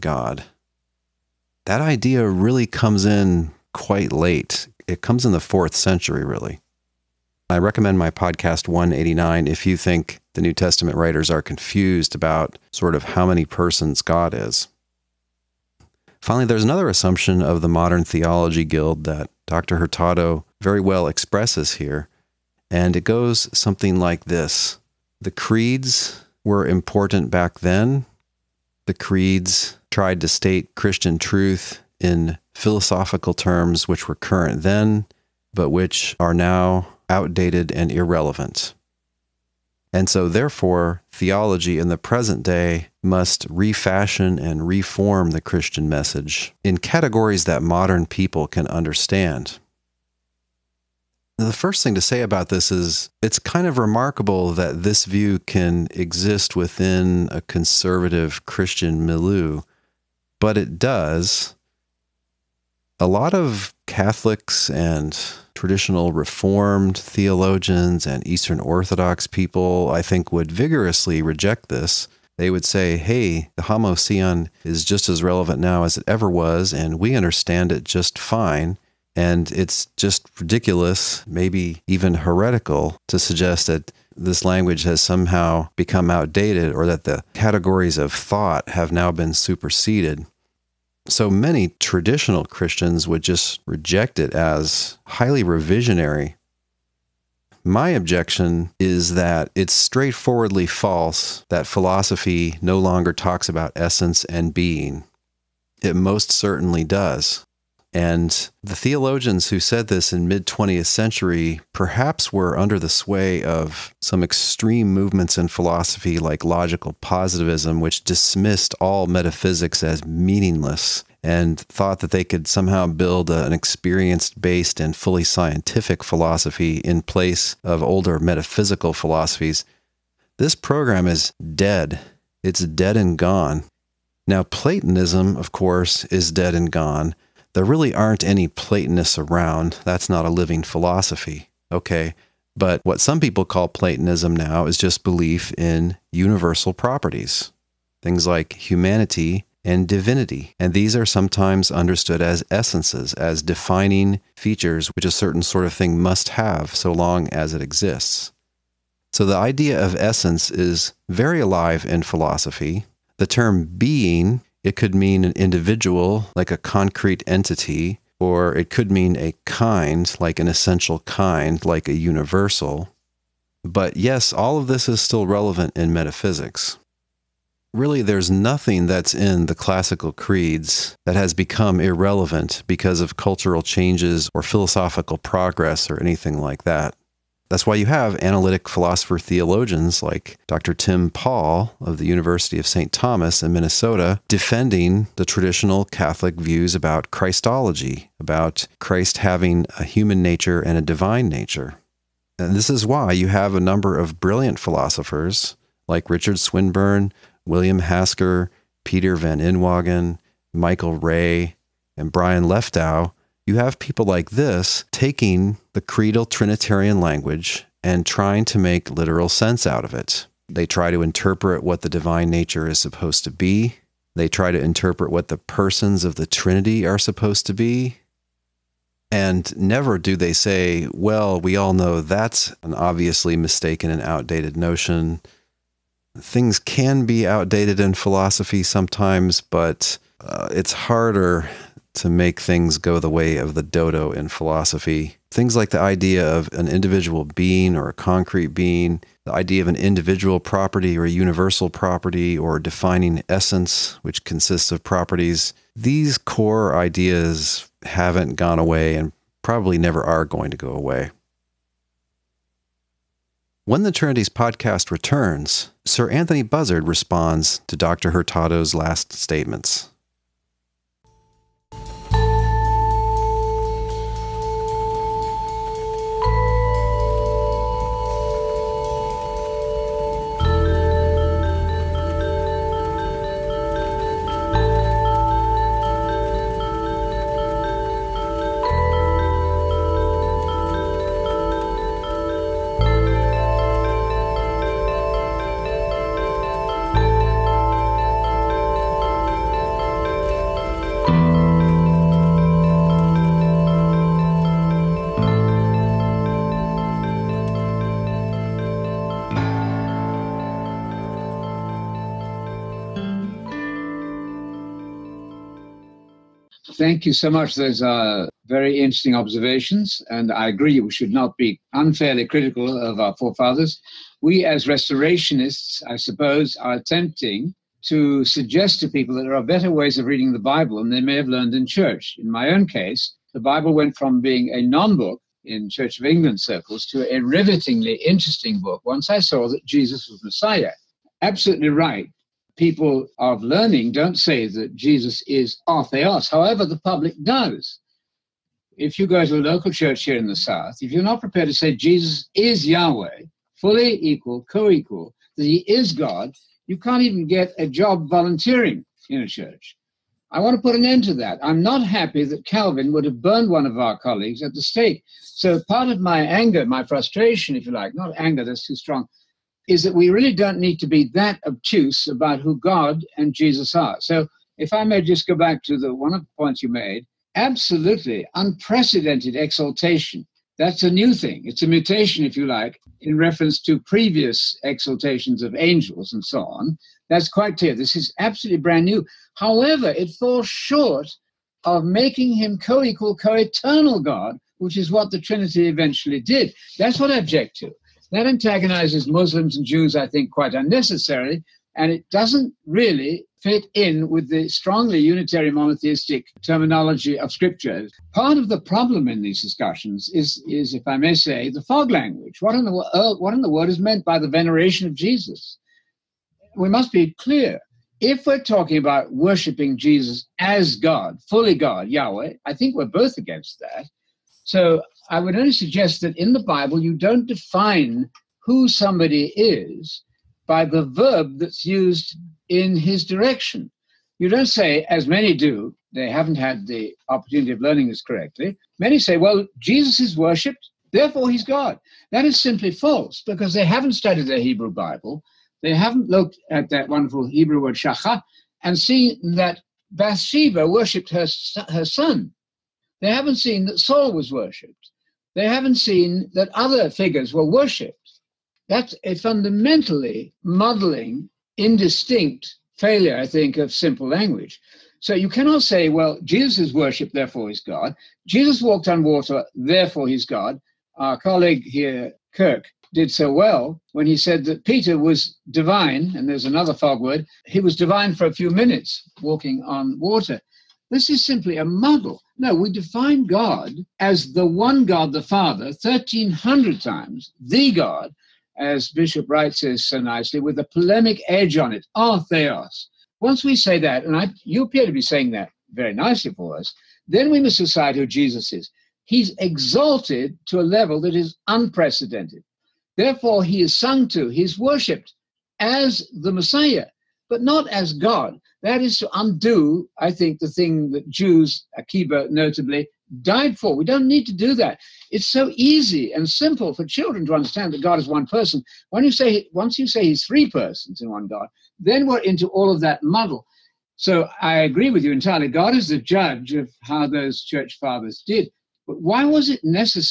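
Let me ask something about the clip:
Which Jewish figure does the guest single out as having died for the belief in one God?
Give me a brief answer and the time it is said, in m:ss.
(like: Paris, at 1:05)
Akiba, at 8:31.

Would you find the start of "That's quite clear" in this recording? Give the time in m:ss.
6:27.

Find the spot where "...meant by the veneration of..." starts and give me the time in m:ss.
6:53.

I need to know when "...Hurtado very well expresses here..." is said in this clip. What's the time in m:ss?
0:19.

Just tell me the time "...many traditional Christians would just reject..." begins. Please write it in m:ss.
1:31.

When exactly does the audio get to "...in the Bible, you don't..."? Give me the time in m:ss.
7:06.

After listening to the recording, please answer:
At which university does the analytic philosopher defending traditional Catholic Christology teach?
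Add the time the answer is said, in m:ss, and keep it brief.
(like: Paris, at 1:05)
University of St. Thomas, at 3:12.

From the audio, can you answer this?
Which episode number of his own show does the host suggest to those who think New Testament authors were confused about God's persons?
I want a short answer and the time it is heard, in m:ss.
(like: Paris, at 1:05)
189, at 0:08.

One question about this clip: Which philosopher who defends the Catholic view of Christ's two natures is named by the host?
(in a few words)
Tim Pawl.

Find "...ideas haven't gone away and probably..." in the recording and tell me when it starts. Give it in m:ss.
4:16.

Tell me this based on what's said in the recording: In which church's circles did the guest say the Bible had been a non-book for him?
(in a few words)
Church of England.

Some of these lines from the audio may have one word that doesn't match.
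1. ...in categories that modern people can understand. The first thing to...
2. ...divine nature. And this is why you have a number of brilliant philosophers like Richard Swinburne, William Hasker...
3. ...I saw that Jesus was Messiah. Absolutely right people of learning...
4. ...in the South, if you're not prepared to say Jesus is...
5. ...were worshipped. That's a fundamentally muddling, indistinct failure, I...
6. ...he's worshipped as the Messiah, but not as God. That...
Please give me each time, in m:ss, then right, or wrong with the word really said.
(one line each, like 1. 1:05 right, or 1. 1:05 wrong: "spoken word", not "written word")
1. 0:46 right
2. 3:20 right
3. 5:39 right
4. 5:50 right
5. 7:37 right
6. 8:24 right.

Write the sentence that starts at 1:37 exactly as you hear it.
My objection is that it's straightforwardly false that philosophy no longer talks about essence and being.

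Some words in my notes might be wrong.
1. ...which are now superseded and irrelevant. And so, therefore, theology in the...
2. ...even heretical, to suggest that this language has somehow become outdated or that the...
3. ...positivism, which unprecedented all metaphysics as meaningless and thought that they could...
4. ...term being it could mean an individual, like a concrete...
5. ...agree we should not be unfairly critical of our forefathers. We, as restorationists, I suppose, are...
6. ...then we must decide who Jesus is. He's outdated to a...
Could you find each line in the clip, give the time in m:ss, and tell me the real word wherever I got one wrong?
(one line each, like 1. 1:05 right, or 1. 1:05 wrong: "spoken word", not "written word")
1. 0:35 wrong: "outdated", not "superseded"
2. 1:21 right
3. 1:56 wrong: "dismissed", not "unprecedented"
4. 2:43 right
5. 5:20 right
6. 8:17 wrong: "exalted", not "outdated".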